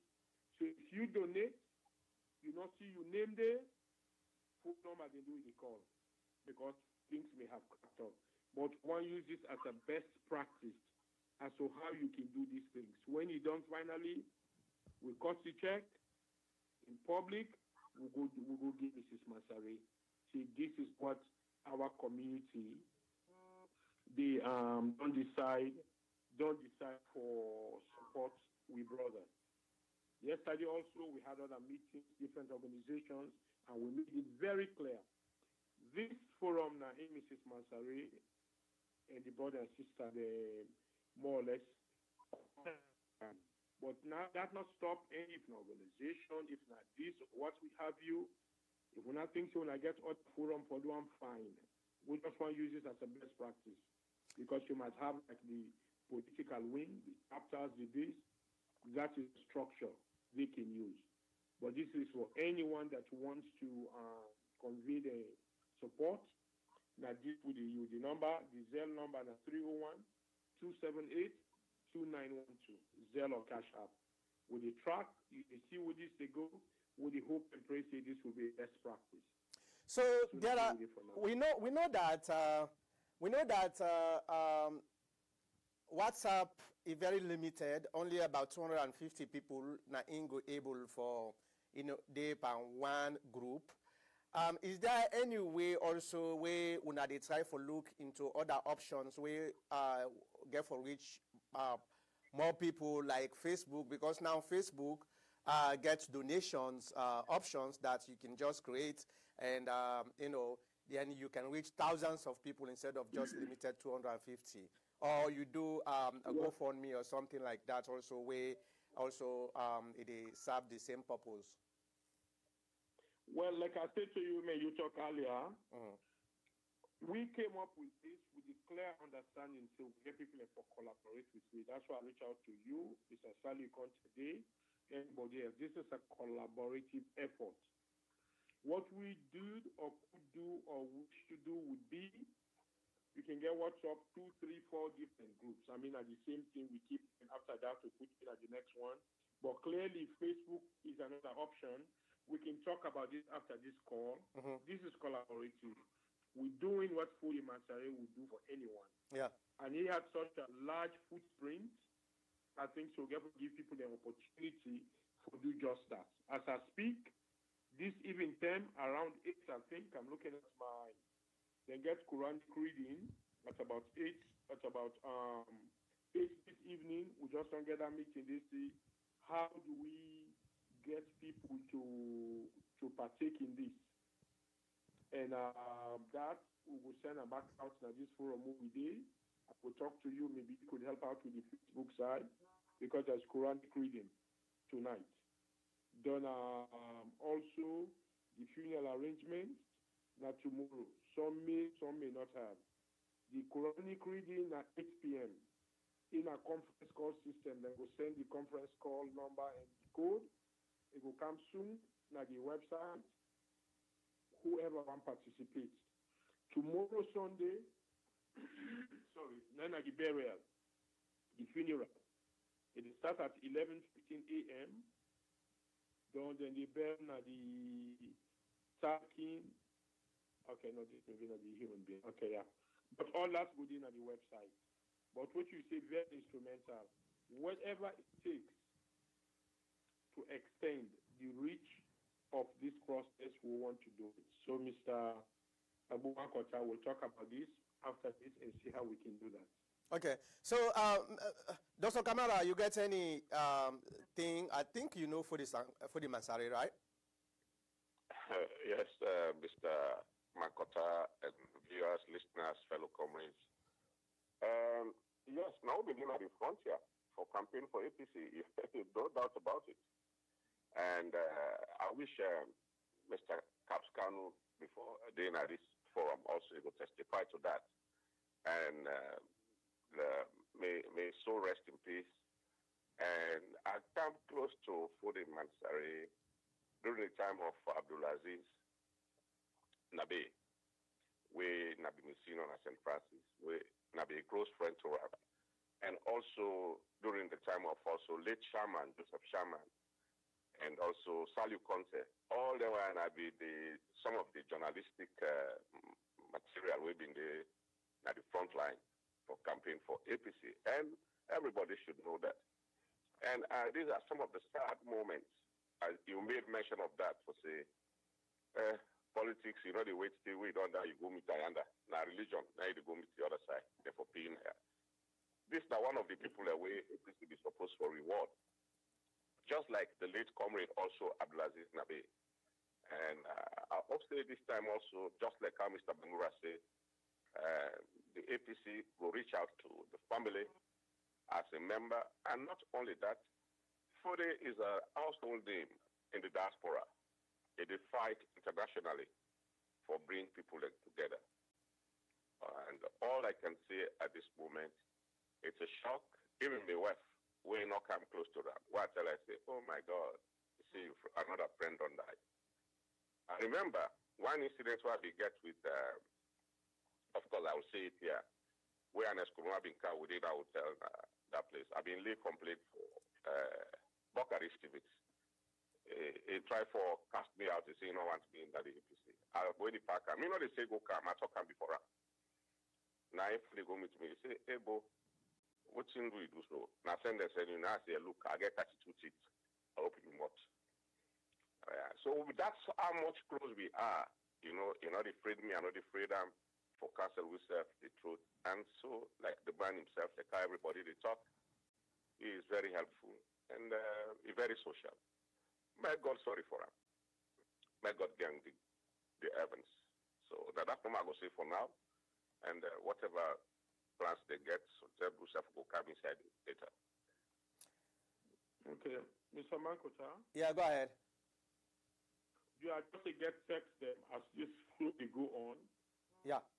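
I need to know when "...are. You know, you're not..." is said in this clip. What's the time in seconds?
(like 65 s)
393 s.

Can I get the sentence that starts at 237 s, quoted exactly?
Whatever it takes to extend the reach of this process, we want to do it.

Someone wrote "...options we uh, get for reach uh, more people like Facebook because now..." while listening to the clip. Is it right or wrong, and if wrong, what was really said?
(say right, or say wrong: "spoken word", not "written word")
right.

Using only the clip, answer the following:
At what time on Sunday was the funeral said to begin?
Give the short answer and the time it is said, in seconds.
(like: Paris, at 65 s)
11:15 a.m., at 223 s.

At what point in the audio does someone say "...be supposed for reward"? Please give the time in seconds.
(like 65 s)
327 s.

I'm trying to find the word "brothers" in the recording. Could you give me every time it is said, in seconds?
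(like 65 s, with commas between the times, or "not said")
28 s, 39 s.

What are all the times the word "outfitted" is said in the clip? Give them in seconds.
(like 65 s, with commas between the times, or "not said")
not said.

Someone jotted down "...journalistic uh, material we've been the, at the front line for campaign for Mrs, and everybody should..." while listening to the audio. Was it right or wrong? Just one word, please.
wrong.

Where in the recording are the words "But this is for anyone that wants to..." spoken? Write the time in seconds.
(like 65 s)
61 s.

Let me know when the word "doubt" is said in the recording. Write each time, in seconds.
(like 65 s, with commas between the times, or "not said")
269 s.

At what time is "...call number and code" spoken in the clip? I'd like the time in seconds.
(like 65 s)
208 s.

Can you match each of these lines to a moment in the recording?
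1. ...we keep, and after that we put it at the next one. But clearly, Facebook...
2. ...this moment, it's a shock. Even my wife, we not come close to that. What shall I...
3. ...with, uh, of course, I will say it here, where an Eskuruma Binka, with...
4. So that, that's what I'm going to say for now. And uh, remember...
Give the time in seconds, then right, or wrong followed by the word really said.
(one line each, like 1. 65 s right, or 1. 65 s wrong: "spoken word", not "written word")
1. 146 s right
2. 354 s right
3. 365 s right
4. 410 s wrong: "whatever", not "remember".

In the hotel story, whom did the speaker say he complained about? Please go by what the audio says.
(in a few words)
Bokari Stevens.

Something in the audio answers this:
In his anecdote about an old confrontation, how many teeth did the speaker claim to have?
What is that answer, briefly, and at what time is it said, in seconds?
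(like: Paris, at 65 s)
32, at 388 s.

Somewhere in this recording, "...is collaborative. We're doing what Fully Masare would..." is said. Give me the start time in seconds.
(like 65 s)
154 s.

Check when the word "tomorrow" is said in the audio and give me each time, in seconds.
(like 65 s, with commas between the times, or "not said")
200 s, 216 s.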